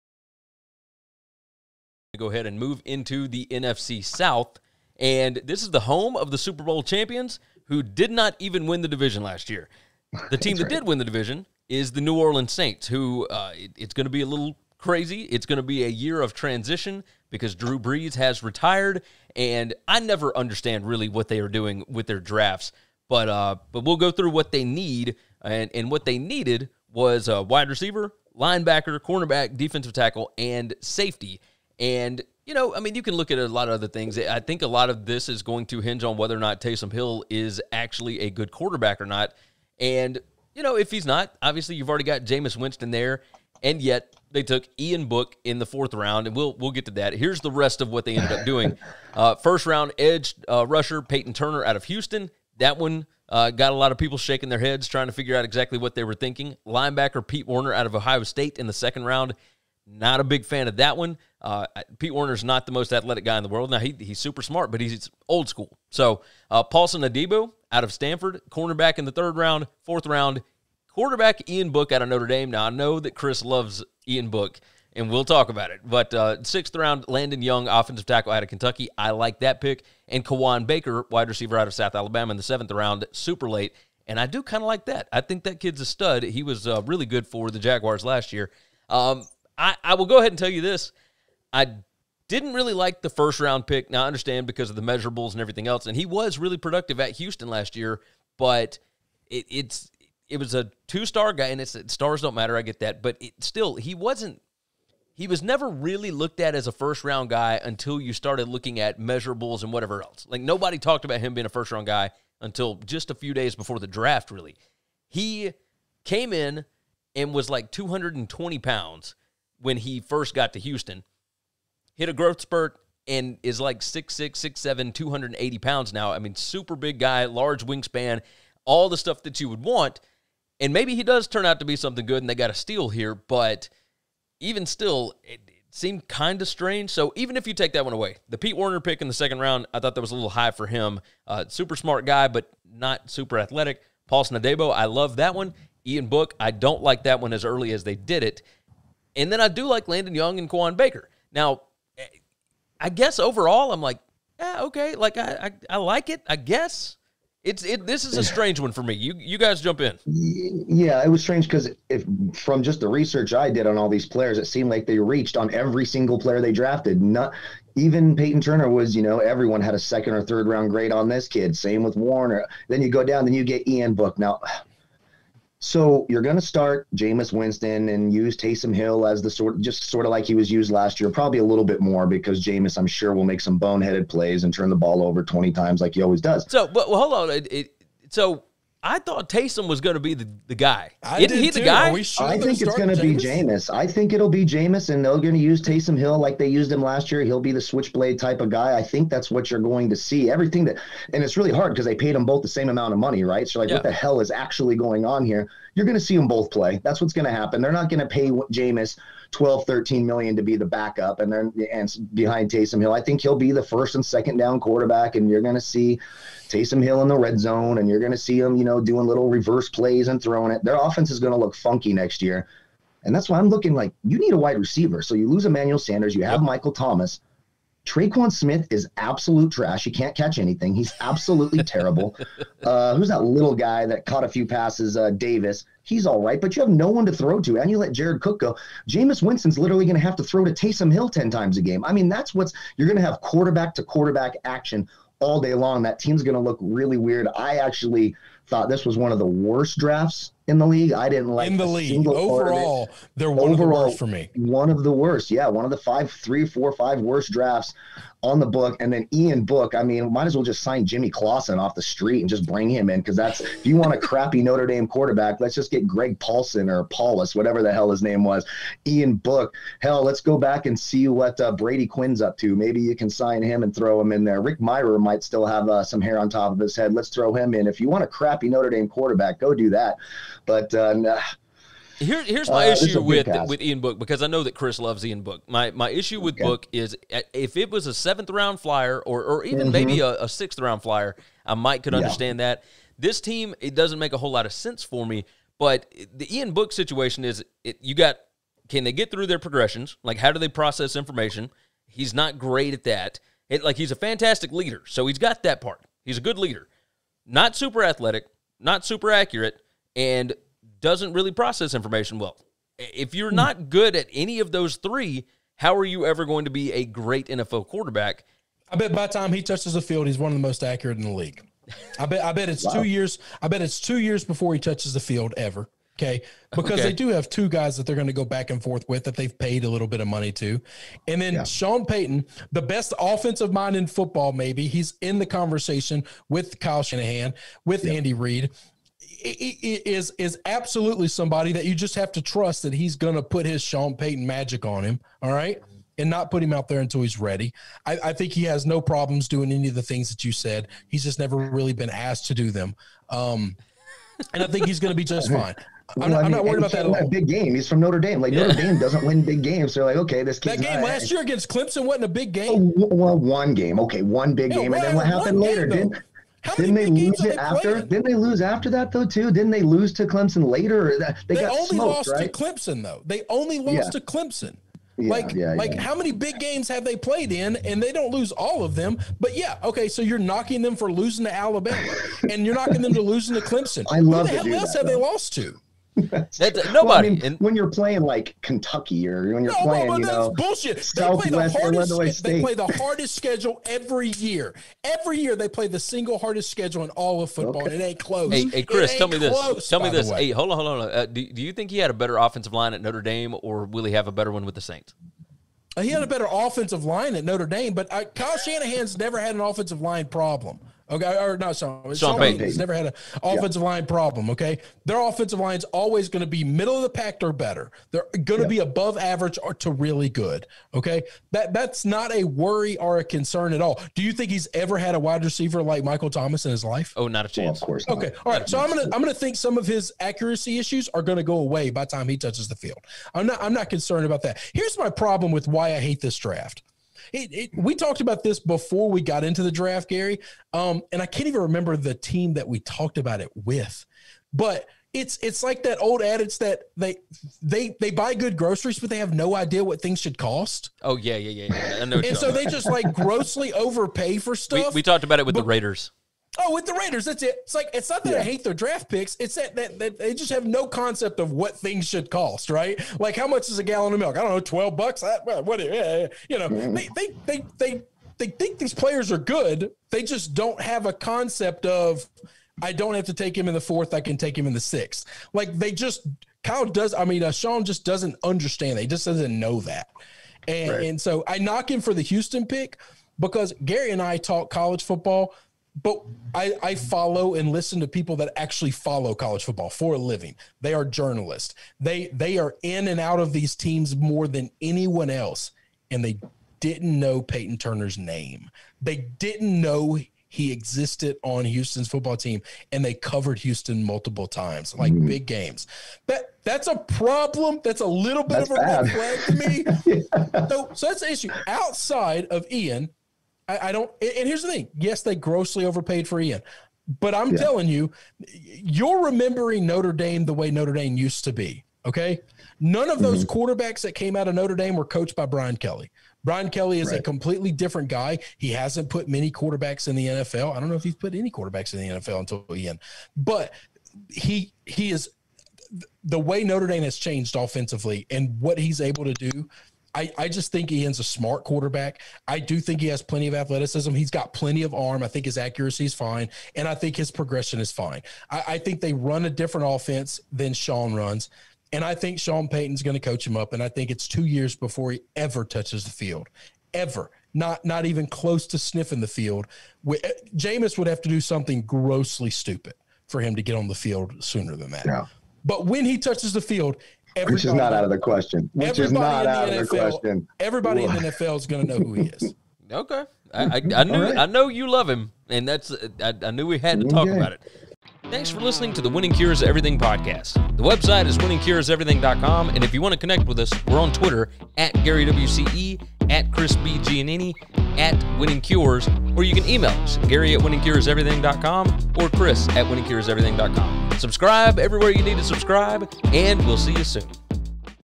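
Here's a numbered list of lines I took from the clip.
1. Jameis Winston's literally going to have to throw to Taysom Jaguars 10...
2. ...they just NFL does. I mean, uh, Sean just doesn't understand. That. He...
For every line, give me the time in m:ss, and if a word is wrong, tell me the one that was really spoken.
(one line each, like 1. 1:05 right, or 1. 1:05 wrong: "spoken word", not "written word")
1. 3:58 wrong: "Hill", not "Jaguars"
2. 7:55 wrong: "Kyle", not "NFL".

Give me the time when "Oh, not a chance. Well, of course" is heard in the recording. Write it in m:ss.
7:06.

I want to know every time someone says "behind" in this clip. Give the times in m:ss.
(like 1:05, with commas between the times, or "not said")
3:32.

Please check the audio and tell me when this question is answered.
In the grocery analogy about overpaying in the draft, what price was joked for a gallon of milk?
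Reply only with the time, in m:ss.
7:44.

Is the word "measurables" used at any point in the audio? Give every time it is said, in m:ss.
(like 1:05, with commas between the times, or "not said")
1:34, 1:48.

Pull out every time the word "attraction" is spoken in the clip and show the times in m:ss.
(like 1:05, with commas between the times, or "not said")
not said.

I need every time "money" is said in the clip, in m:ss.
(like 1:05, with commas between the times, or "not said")
3:22, 5:30.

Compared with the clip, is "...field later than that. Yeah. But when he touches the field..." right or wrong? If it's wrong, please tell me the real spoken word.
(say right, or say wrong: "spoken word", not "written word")
wrong: "sooner", not "later".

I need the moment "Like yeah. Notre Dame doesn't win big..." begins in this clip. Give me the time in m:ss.
5:58.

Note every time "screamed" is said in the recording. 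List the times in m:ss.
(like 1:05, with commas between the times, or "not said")
not said.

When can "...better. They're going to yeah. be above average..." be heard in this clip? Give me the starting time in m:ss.
6:57.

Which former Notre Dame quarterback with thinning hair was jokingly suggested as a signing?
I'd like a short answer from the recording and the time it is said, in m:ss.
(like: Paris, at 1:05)
Rick Mirer, at 4:34.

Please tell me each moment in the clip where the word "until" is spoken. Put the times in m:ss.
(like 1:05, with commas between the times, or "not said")
1:47, 1:52, 5:46, 8:52.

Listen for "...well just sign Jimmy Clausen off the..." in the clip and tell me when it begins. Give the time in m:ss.
4:20.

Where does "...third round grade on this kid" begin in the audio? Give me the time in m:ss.
2:50.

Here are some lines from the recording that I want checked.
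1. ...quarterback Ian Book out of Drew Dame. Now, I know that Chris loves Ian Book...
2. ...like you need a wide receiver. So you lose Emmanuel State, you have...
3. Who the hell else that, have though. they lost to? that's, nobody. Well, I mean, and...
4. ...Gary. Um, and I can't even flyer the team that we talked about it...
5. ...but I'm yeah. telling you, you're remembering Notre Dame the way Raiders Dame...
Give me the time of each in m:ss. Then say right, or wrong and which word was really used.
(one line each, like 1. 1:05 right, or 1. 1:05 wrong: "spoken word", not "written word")
1. 1:10 wrong: "Notre", not "Drew"
2. 3:43 wrong: "Sanders", not "State"
3. 6:24 right
4. 7:19 wrong: "remember", not "flyer"
5. 8:37 wrong: "Notre", not "Raiders".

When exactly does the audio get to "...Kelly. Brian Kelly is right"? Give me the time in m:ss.
8:45.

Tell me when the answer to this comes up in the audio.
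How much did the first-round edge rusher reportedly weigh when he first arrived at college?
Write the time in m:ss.
1:57.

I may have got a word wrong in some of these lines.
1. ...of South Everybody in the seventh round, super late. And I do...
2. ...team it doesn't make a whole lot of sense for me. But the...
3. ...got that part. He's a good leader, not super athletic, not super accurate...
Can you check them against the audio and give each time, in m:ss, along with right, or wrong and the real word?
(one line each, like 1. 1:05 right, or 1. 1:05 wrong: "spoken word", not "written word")
1. 1:21 wrong: "Alabama", not "Everybody"
2. 4:53 right
3. 5:05 right.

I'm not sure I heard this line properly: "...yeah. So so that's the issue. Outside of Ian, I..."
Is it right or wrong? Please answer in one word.
right.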